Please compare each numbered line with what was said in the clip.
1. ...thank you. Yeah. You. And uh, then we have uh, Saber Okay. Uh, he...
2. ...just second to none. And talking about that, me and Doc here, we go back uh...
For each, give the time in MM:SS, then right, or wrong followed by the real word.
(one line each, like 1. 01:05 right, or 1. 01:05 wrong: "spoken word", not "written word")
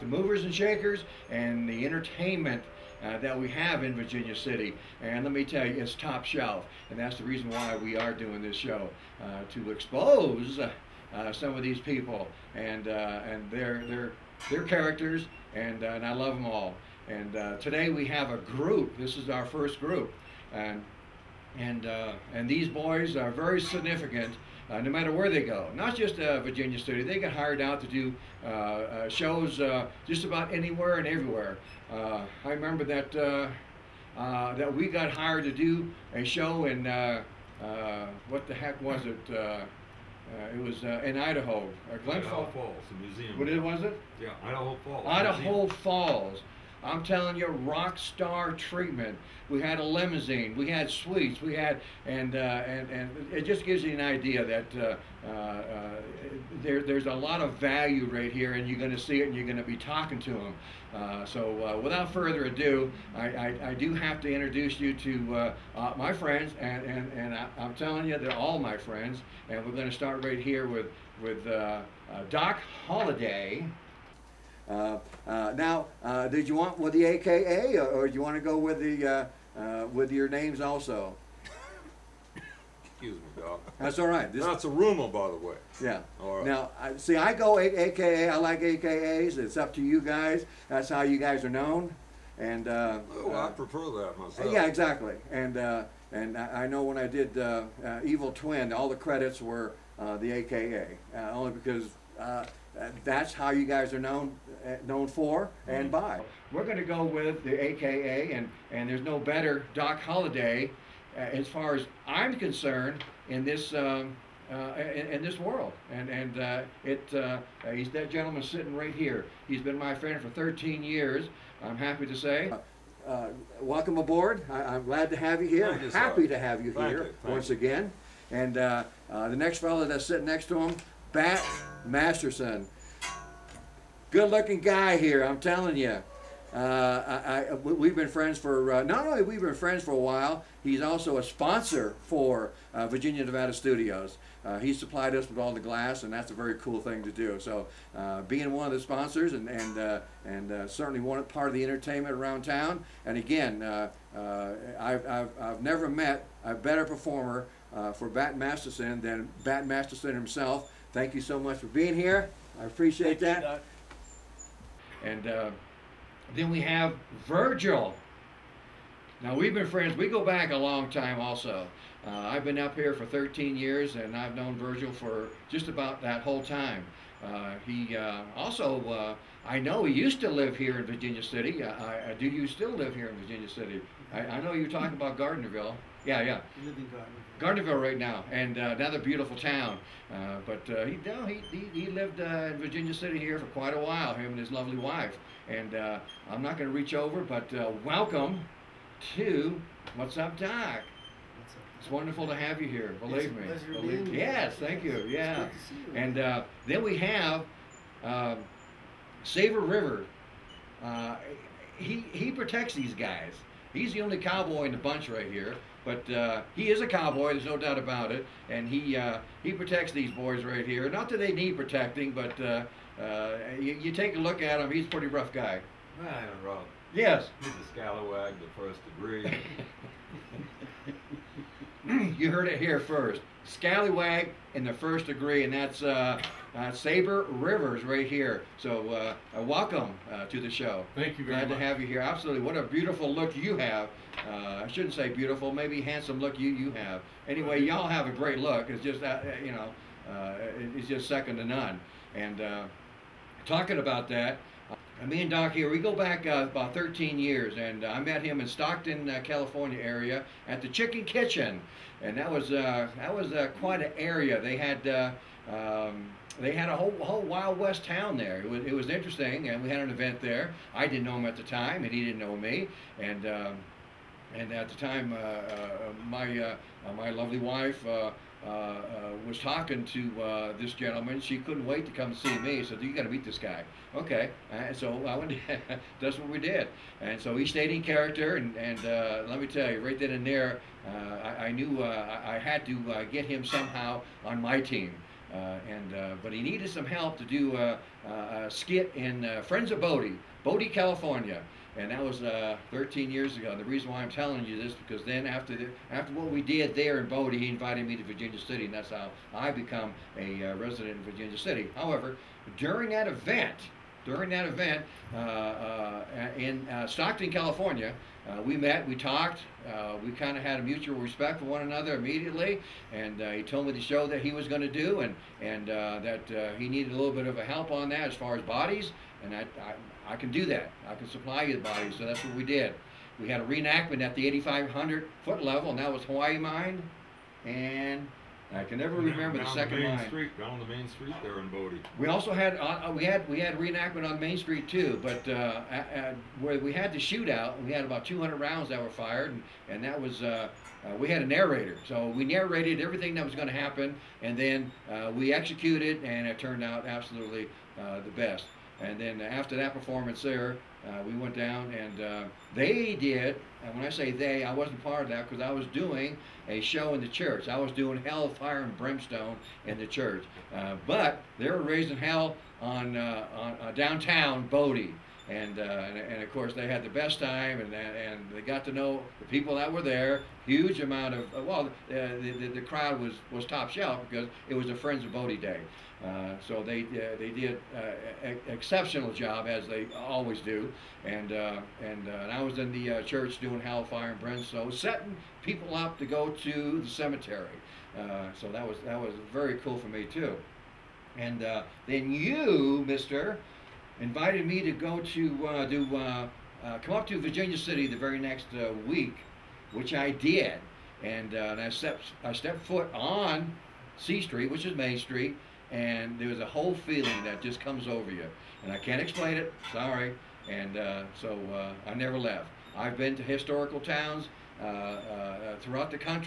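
1. 03:24 wrong: "River", not "Okay"
2. 04:10 right.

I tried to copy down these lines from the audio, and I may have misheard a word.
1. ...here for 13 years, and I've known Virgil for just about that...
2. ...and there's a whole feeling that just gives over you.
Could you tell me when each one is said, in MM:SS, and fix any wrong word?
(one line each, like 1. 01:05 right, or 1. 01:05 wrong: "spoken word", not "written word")
1. 02:52 right
2. 06:55 wrong: "comes", not "gives".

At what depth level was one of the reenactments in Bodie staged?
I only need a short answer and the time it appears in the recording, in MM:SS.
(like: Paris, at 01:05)
8,500 foot level, at 05:34.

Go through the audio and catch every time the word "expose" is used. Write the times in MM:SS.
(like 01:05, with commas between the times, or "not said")
00:09.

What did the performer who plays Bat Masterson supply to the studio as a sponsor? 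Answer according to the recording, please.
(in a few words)
All the glass.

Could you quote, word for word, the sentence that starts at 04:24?
They had um, they had a whole whole Wild West town there.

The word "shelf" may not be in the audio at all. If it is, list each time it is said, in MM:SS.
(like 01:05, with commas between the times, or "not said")
00:06, 06:23.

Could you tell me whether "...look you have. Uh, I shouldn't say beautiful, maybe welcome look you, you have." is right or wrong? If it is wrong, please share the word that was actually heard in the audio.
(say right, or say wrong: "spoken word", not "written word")
wrong: "handsome", not "welcome".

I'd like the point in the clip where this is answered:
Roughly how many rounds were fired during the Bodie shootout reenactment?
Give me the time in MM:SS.
05:48.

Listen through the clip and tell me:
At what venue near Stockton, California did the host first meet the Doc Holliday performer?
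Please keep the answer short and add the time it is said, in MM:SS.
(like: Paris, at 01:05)
Chicken Kitchen, at 04:20.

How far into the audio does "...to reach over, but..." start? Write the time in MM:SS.
03:16.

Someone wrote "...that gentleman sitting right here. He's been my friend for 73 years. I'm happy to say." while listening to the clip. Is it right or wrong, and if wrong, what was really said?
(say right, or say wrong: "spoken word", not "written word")
wrong: "13", not "73".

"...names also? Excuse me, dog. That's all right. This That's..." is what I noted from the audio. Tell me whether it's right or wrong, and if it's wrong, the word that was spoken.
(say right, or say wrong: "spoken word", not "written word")
right.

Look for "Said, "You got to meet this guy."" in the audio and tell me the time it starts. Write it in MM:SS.
04:42.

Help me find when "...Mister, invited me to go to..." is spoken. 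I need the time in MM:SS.
06:42.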